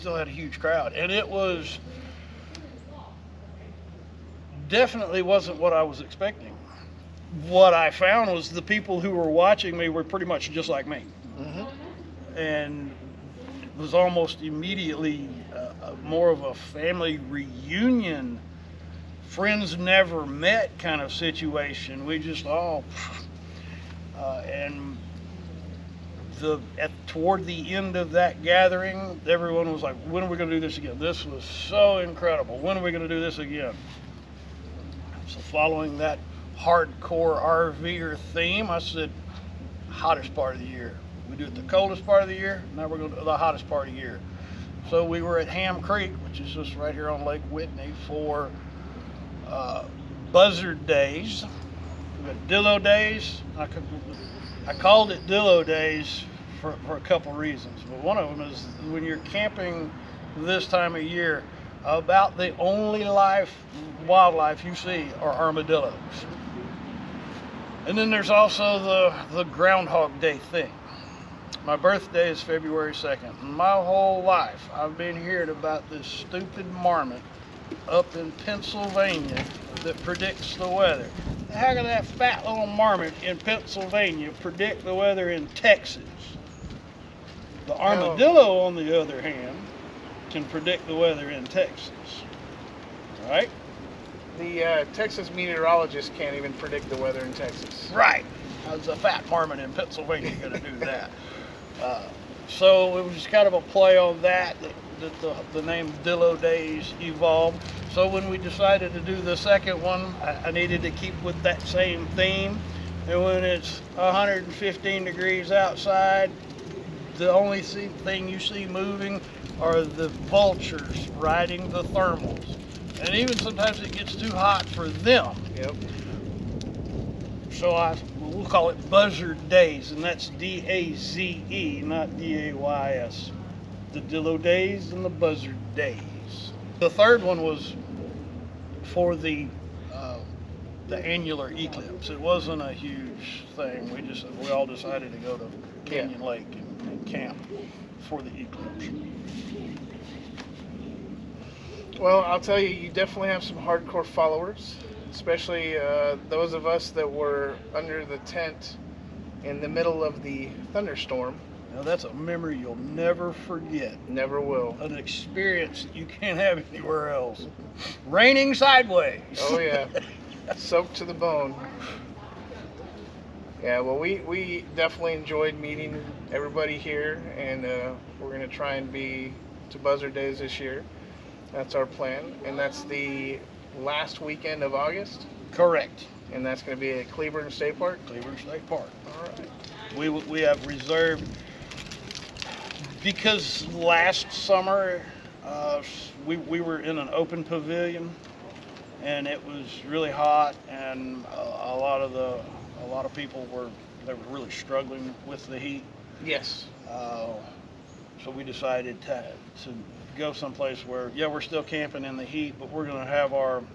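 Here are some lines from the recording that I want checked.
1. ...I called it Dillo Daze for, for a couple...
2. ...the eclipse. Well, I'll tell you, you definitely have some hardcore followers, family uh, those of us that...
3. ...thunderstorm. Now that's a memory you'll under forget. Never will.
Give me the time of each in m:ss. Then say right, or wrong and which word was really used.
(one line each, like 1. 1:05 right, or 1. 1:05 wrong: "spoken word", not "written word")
1. 0:54 right
2. 2:28 wrong: "especially", not "family"
3. 2:40 wrong: "never", not "under".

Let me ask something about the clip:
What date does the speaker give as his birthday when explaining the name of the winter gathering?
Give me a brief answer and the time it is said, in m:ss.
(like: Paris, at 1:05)
February 2nd, at 1:12.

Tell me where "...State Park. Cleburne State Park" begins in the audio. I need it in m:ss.
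3:07.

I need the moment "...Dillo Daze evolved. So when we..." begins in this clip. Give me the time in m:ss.
1:46.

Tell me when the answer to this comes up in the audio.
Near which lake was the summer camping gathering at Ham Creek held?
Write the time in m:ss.
0:47.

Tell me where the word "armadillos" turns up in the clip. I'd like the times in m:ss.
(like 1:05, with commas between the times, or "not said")
1:05, 1:27.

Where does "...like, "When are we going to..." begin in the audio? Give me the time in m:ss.
0:29.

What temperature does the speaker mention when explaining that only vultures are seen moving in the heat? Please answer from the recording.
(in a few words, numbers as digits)
115 degrees.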